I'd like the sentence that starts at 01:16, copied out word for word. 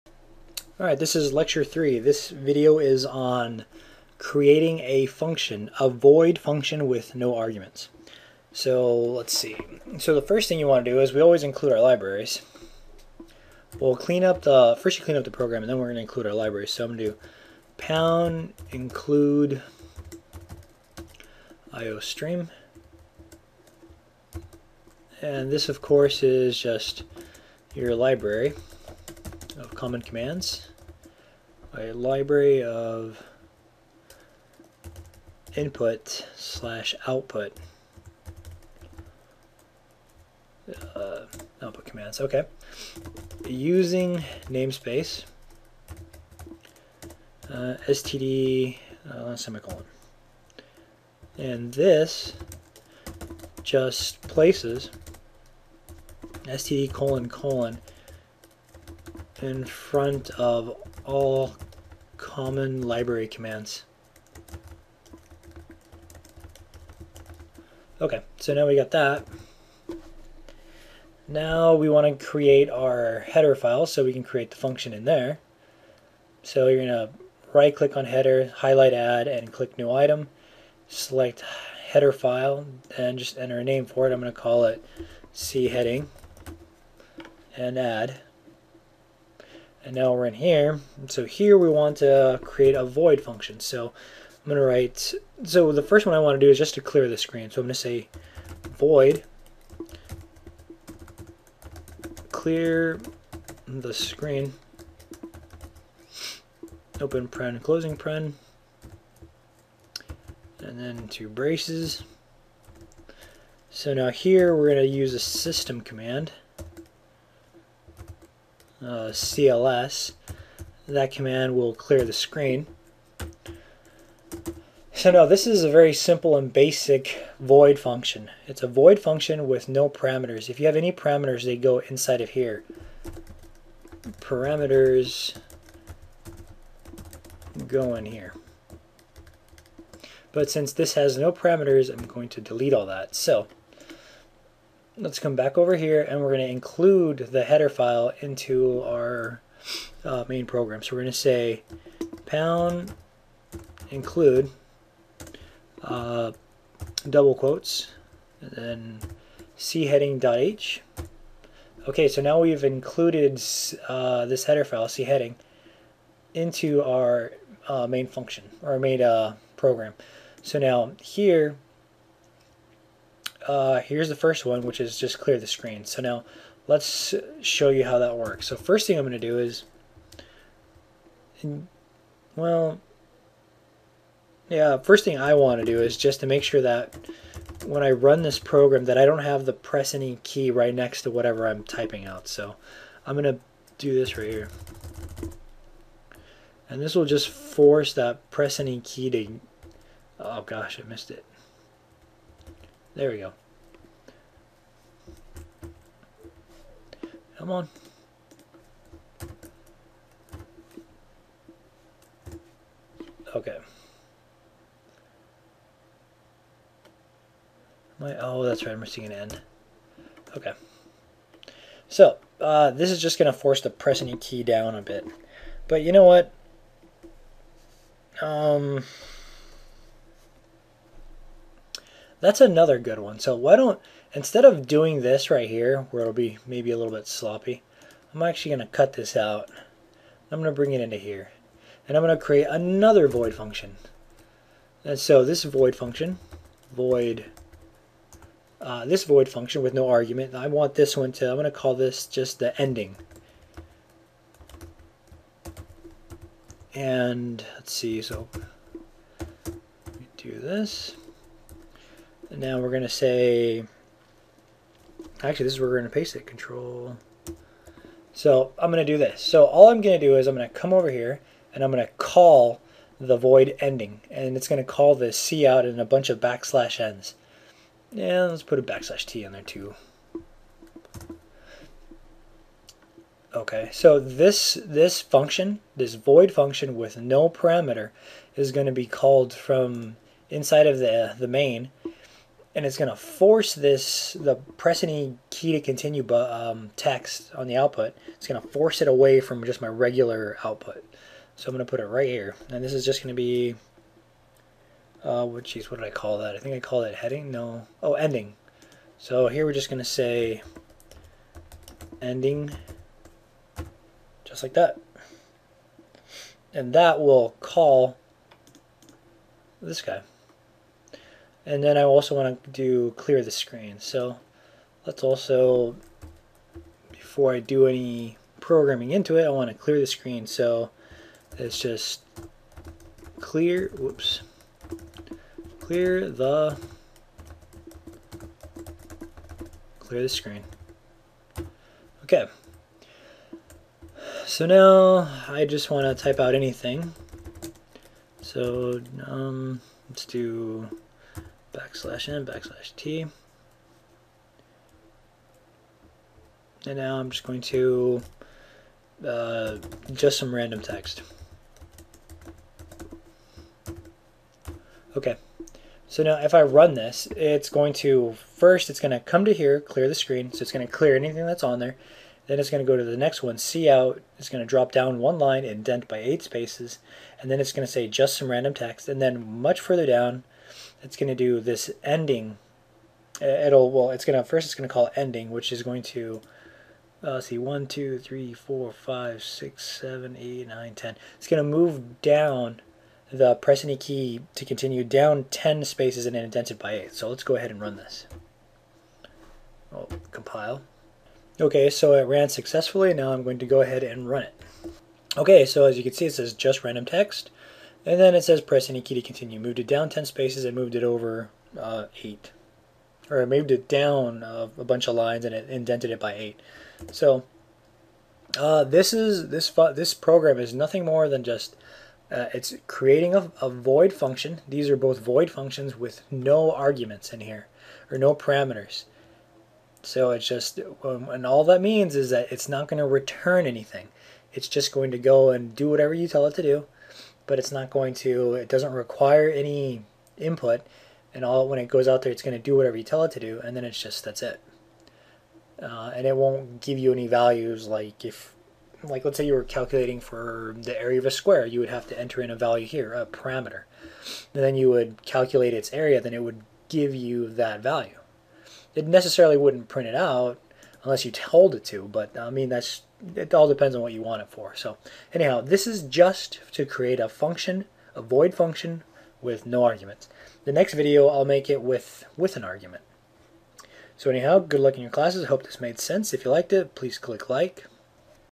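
So you're going to right click on header, highlight add, and click new item.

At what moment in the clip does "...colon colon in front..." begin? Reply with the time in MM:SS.
00:56.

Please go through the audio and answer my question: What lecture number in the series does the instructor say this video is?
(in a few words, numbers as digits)
3.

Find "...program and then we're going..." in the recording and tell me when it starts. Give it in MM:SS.
00:15.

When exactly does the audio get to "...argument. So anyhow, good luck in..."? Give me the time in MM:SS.
07:52.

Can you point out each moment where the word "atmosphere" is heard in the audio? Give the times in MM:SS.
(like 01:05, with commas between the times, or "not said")
not said.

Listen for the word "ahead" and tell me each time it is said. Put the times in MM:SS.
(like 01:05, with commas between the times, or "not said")
06:37, 06:43.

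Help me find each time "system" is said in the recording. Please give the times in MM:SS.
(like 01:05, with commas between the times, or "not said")
01:55.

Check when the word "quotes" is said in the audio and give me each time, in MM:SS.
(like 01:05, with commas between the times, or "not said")
02:37.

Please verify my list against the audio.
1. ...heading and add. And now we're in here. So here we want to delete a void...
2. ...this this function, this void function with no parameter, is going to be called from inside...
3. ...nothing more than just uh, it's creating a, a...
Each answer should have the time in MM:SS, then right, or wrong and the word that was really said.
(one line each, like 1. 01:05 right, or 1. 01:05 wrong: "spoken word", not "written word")
1. 01:25 wrong: "create", not "delete"
2. 04:43 right
3. 07:00 right.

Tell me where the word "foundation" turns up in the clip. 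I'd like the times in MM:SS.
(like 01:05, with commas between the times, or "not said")
not said.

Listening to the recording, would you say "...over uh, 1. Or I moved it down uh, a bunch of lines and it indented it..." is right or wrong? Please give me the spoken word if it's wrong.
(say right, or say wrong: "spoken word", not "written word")
wrong: "8", not "1".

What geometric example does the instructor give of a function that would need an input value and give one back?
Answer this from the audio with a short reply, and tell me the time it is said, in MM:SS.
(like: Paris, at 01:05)
area of a square, at 07:30.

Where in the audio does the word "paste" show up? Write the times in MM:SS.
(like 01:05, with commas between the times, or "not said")
04:25.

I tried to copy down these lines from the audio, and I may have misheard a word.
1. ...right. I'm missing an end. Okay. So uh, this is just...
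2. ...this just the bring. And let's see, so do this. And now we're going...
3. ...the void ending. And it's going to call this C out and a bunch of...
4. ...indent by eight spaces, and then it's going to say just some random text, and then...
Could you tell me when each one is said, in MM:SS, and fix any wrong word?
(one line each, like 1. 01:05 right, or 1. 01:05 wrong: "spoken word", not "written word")
1. 03:38 right
2. 04:11 wrong: "ending", not "bring"
3. 04:33 right
4. 06:15 right.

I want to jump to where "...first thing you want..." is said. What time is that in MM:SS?
00:10.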